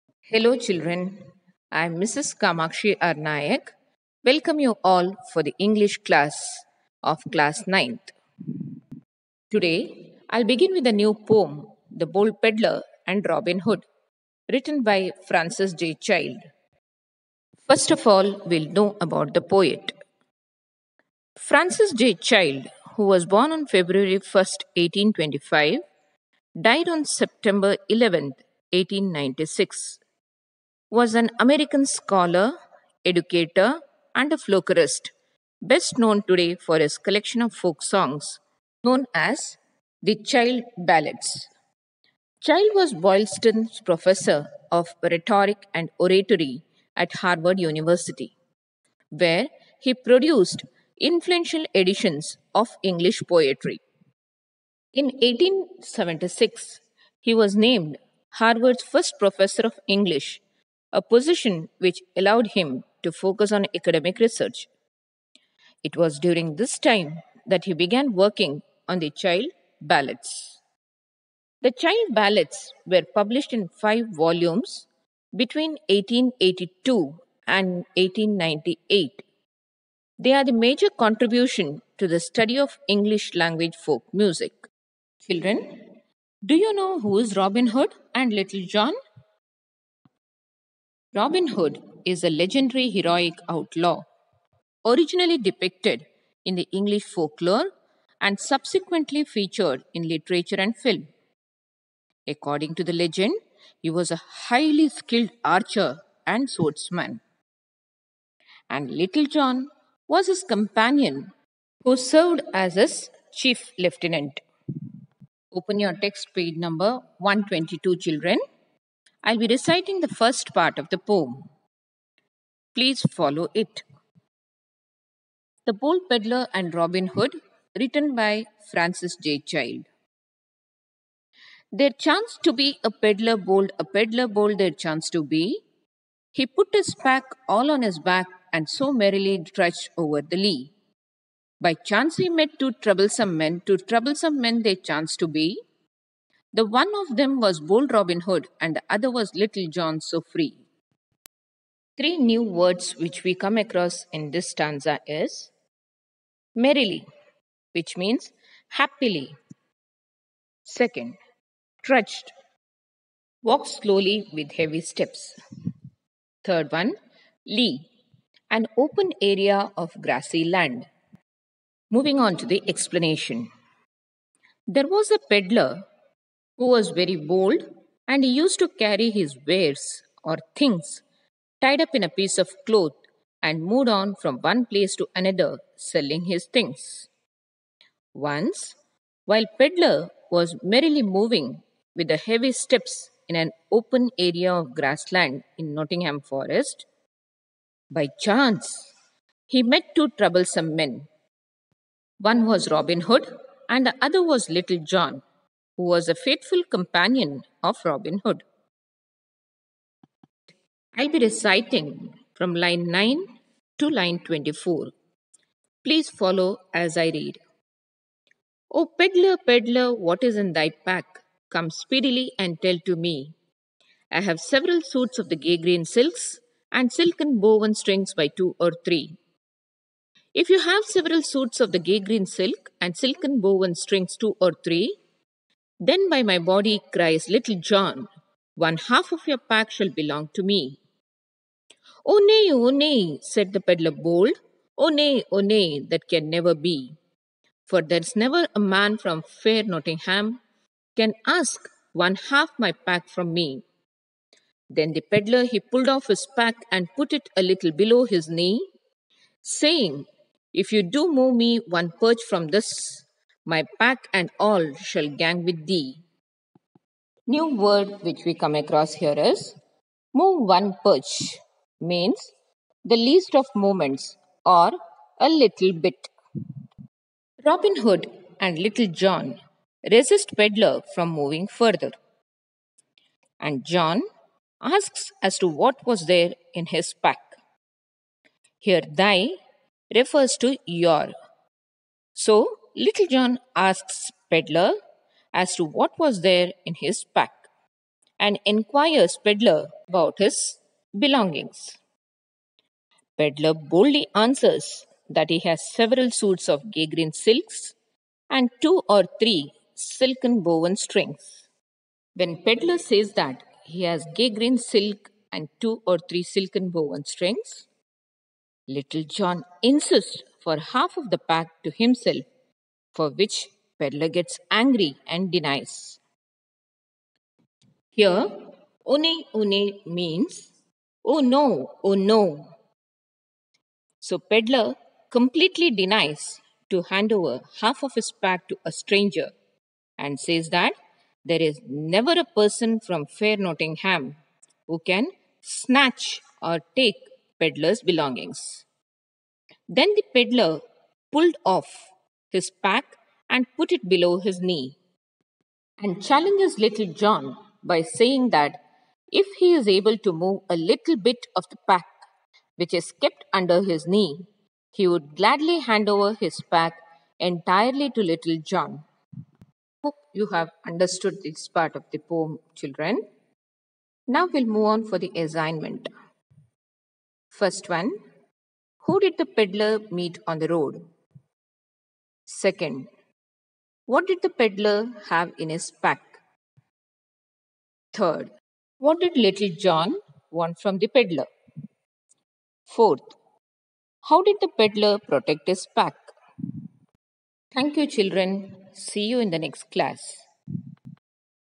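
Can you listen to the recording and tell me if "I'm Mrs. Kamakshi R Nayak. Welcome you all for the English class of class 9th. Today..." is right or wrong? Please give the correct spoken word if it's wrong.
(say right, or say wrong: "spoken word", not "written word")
right.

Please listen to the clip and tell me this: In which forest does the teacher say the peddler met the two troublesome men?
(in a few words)
Nottingham Forest.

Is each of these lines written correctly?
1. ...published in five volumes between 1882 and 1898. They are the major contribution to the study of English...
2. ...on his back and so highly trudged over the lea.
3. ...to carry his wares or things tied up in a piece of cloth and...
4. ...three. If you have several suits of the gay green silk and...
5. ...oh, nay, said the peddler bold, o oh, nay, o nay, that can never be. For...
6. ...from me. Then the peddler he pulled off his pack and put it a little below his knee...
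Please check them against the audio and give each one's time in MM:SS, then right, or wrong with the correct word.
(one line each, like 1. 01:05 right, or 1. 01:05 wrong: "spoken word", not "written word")
1. 01:13 right
2. 02:17 wrong: "merrily", not "highly"
3. 02:58 right
4. 03:48 right
5. 04:02 right
6. 04:13 right.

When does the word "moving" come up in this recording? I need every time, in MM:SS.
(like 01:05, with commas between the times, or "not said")
02:51, 03:11, 04:41.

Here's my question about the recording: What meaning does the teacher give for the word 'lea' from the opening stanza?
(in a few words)
An open area of grassy land.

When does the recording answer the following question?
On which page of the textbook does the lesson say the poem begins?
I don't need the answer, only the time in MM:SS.
01:56.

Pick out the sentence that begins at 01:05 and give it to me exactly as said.
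It was during this time that he began working on the child ballads.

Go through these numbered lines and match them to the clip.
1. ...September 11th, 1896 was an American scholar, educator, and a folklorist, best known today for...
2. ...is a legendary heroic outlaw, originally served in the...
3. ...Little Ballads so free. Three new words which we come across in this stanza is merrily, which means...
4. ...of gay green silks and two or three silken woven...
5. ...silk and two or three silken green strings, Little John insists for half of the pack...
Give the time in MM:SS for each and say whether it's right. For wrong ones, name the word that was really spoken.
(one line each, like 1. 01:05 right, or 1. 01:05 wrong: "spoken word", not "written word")
1. 00:27 right
2. 01:32 wrong: "depicted", not "served"
3. 02:29 wrong: "John", not "Ballads"
4. 05:06 right
5. 05:14 wrong: "woven", not "green".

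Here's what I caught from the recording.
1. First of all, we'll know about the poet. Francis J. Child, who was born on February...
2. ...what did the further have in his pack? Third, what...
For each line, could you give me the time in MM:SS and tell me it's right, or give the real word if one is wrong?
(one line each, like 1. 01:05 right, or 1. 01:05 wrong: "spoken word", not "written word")
1. 00:17 right
2. 06:23 wrong: "peddler", not "further".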